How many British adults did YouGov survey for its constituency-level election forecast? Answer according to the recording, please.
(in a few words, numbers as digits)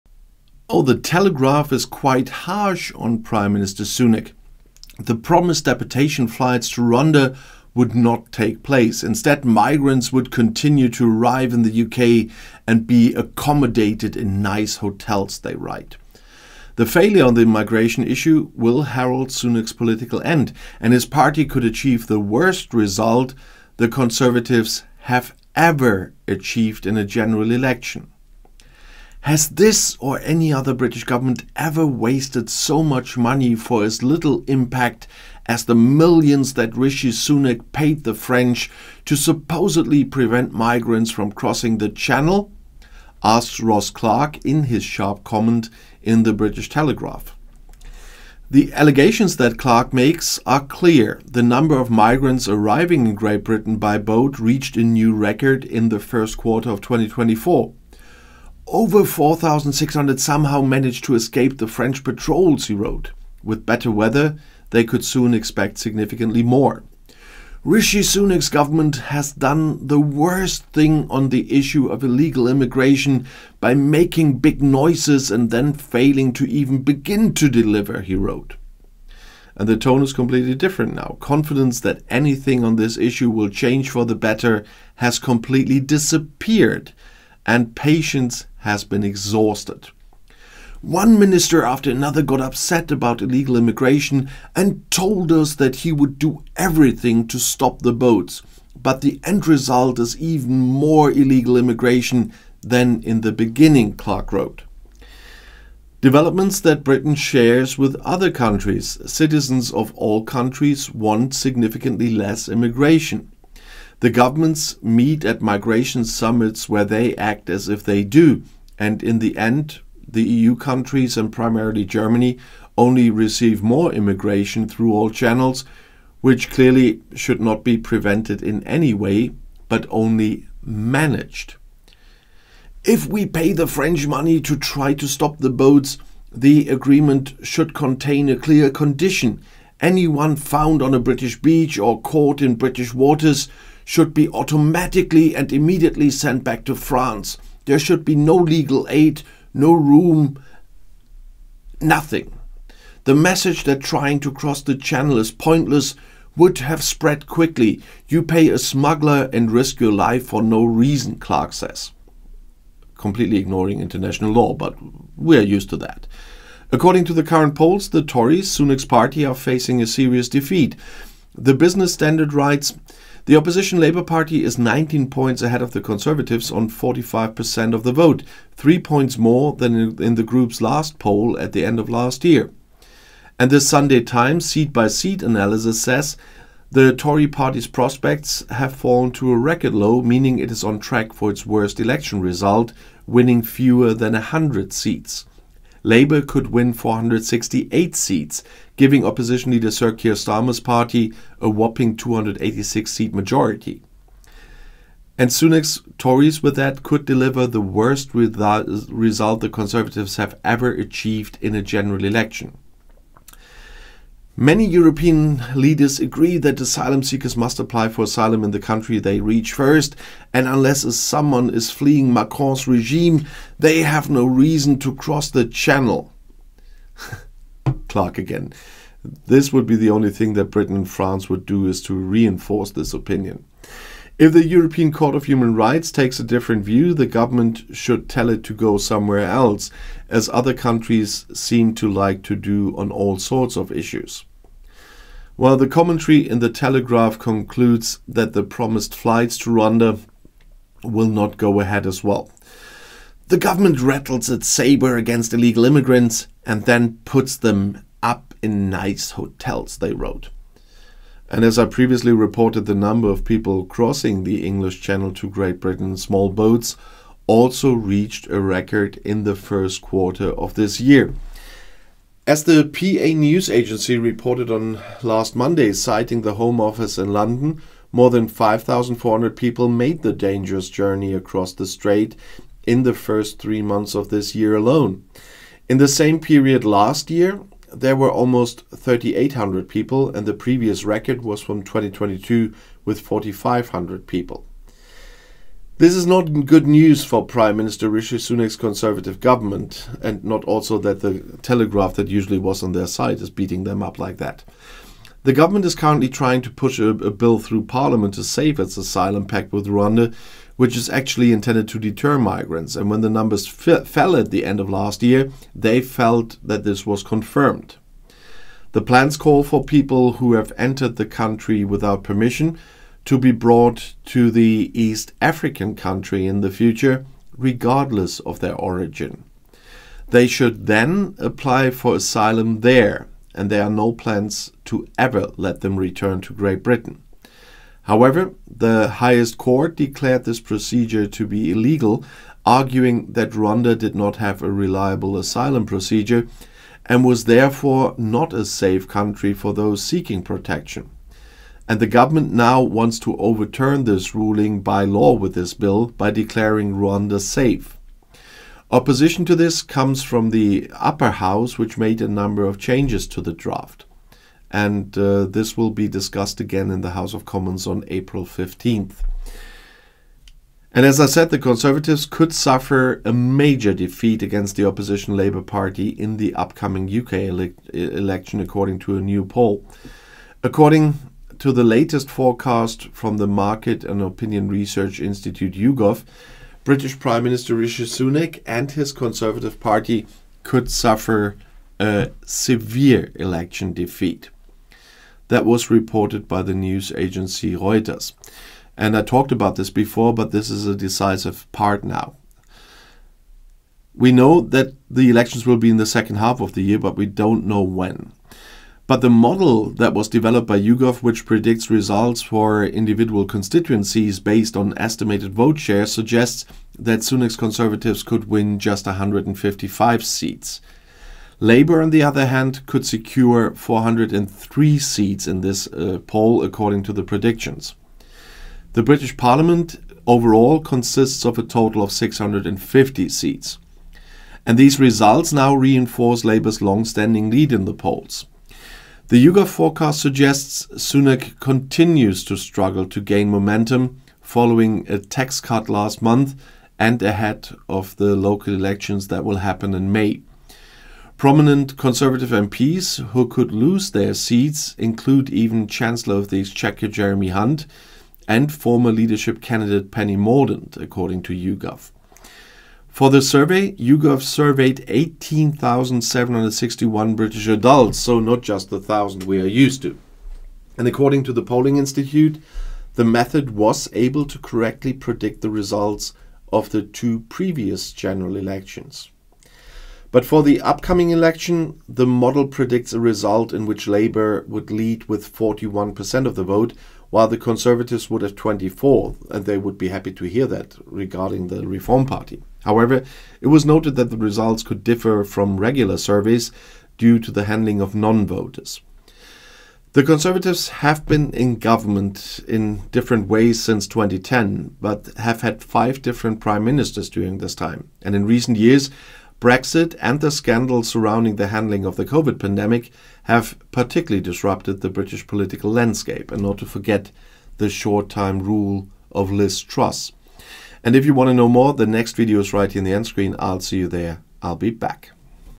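18,761.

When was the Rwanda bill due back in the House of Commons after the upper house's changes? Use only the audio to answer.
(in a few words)
April 15th.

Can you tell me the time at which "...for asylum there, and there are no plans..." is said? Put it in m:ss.
5:31.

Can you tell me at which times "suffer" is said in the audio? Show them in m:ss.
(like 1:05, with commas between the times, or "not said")
6:12, 6:30.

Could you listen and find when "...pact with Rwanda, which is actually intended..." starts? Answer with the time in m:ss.
5:09.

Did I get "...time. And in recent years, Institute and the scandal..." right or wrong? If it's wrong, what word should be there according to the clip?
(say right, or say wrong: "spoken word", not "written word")
wrong: "Brexit", not "Institute".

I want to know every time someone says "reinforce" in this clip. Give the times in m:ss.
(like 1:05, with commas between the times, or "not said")
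3:51, 7:15.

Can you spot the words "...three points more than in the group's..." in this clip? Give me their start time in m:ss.
2:58.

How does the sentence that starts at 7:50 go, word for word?
And according to the Polling Institute, the method was able to correctly predict the results of the two previous general elections.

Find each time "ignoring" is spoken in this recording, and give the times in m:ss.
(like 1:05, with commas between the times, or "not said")
2:43.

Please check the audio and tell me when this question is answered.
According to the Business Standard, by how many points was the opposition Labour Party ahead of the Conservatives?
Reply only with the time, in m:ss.
2:54.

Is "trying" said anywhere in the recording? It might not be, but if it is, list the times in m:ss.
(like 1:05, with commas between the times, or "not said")
2:33, 5:06.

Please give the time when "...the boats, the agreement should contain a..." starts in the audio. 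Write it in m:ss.
2:15.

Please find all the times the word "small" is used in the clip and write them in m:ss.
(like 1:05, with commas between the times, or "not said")
4:25.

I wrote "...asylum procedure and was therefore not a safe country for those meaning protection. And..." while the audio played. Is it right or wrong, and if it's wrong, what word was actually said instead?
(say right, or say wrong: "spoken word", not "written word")
wrong: "seeking", not "meaning".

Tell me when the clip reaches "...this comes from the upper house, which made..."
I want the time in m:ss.
5:59.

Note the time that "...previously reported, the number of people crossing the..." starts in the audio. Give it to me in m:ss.
4:21.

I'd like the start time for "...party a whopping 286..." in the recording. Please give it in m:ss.
3:20.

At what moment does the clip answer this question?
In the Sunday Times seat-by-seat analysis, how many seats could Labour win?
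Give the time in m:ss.
3:16.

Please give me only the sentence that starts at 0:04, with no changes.
The promised deportation flights to Rwanda would not take place.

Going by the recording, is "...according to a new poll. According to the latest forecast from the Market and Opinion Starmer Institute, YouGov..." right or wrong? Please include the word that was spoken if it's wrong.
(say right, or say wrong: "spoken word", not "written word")
wrong: "Research", not "Starmer".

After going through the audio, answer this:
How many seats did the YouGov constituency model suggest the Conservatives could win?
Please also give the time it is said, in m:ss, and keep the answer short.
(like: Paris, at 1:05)
155, at 6:58.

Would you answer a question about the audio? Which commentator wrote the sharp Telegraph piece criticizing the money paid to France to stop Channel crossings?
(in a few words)
Ross Clark.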